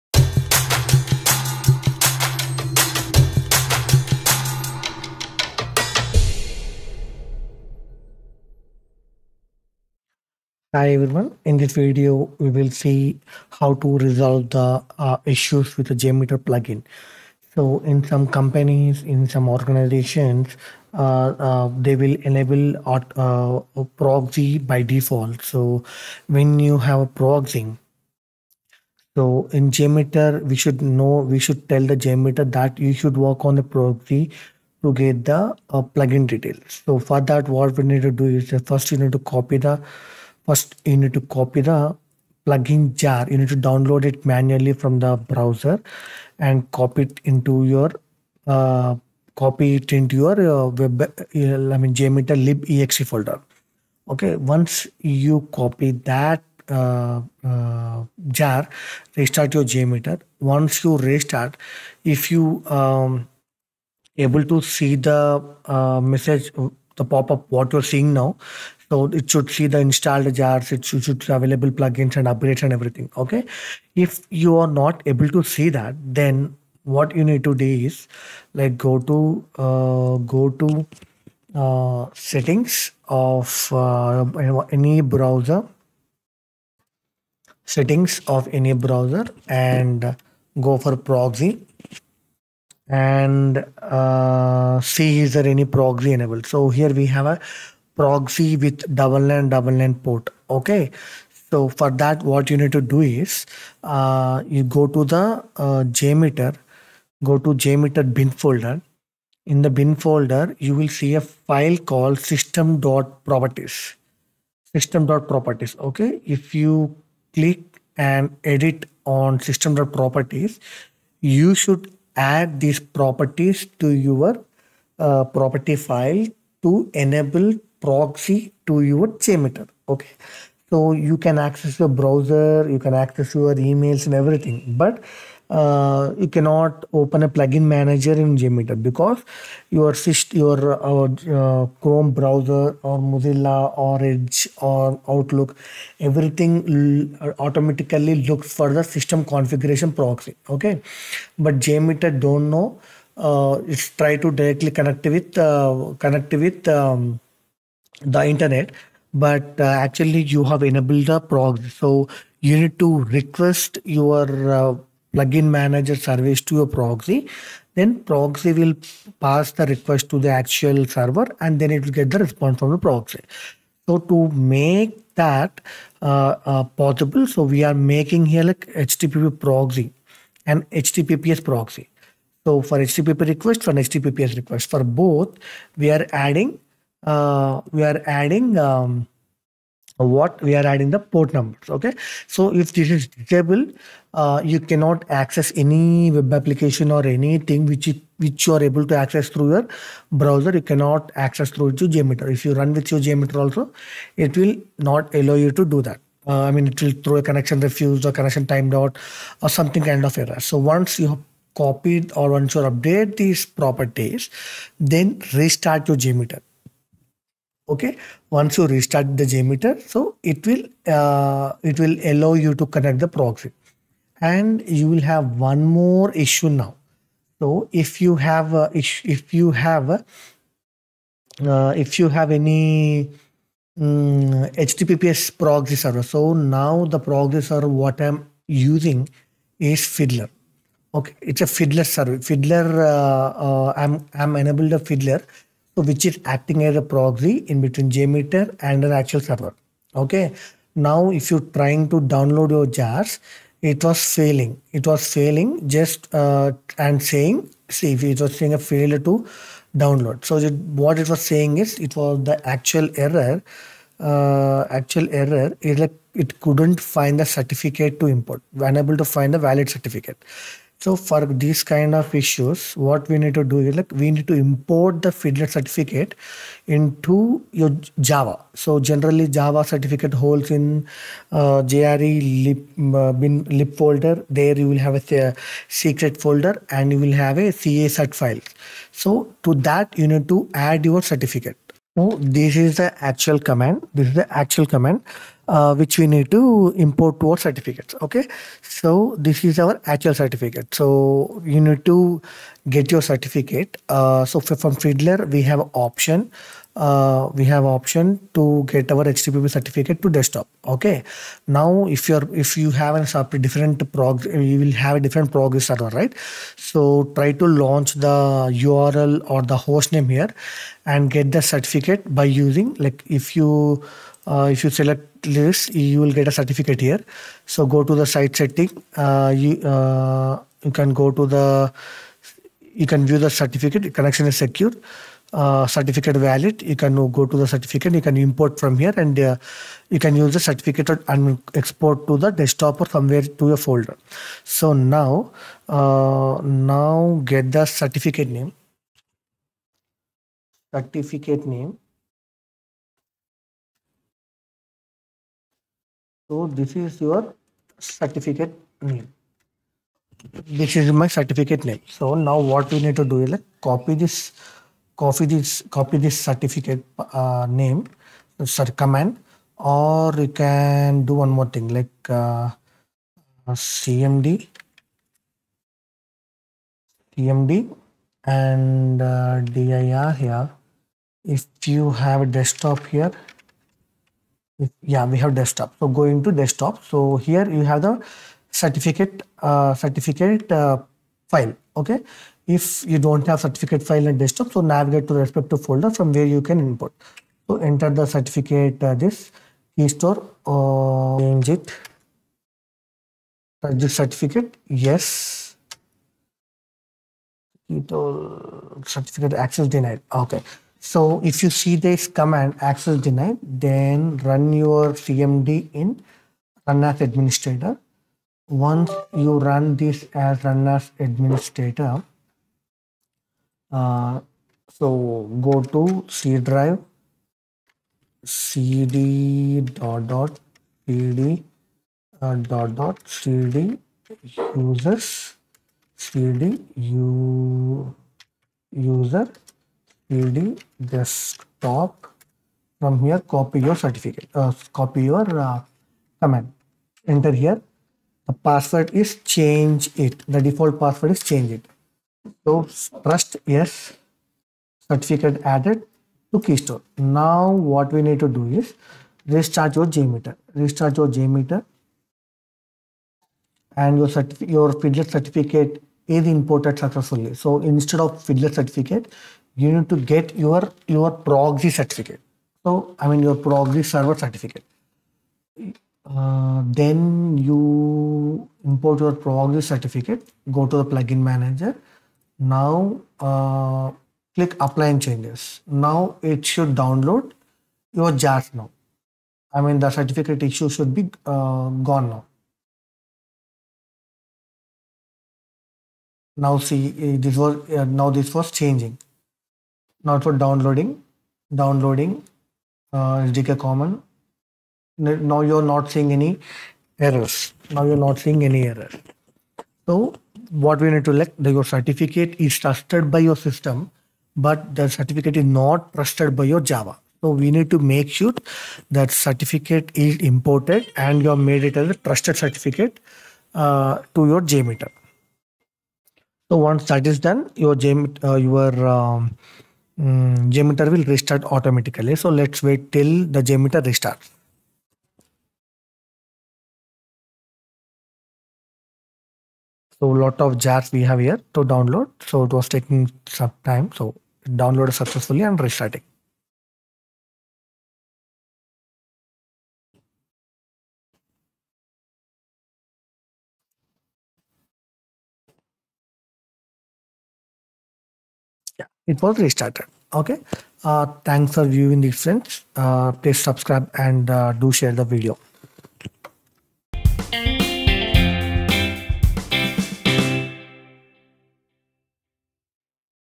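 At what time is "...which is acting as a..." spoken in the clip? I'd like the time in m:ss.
4:05.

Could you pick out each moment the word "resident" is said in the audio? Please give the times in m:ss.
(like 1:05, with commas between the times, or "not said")
not said.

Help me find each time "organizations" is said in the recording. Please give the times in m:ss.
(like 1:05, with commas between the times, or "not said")
0:19.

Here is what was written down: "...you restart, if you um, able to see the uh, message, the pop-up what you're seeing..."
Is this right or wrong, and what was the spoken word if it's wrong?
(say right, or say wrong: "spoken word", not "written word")
right.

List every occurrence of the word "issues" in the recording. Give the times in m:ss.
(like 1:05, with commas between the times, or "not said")
0:15, 3:46, 4:32, 8:10.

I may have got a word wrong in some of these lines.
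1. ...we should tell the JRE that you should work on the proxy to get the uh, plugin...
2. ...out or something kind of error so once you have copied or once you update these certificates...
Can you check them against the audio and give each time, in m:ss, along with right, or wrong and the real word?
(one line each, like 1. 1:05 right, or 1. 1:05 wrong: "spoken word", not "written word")
1. 0:31 wrong: "JMeter", not "JRE"
2. 3:28 wrong: "properties", not "certificates".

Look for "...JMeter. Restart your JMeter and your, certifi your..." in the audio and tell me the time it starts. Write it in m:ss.
7:39.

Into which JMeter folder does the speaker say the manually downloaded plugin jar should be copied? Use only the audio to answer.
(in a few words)
lib.exe folder.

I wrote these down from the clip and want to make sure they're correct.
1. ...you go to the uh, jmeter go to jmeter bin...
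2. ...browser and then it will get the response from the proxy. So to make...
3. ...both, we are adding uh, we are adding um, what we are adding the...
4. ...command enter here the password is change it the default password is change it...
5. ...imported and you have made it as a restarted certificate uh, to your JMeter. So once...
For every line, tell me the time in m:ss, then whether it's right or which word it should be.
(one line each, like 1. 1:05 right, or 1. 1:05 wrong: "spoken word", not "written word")
1. 1:44 right
2. 2:50 wrong: "server", not "browser"
3. 3:04 right
4. 7:26 right
5. 8:40 wrong: "trusted", not "restarted".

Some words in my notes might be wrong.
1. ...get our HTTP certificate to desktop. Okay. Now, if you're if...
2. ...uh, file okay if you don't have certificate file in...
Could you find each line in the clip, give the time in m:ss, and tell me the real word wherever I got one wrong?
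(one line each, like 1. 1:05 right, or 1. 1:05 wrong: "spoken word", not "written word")
1. 5:08 right
2. 6:30 right.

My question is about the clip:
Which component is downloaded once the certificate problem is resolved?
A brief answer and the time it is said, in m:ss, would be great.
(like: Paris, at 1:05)
SDK common, at 8:23.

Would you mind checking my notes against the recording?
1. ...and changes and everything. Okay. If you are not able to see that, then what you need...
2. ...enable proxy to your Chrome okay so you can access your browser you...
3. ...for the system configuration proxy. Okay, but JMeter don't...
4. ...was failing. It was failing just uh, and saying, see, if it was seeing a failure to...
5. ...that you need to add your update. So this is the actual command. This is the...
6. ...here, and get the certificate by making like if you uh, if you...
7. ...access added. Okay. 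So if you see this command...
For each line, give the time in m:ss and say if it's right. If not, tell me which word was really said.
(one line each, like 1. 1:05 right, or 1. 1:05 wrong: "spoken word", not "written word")
1. 1:12 wrong: "upgrades", not "changes"
2. 2:07 wrong: "JMeter", not "Chrome"
3. 2:28 right
4. 4:13 wrong: "saying", not "seeing"
5. 4:49 wrong: "certificate", not "update"
6. 5:20 wrong: "using", not "making"
7. 6:49 wrong: "denied", not "added".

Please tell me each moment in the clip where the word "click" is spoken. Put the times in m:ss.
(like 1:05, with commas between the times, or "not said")
1:57, 8:04.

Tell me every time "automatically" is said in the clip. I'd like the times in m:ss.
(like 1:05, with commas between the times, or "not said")
2:27, 8:51.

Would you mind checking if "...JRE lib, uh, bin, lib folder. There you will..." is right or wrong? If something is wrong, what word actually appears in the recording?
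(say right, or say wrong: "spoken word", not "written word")
right.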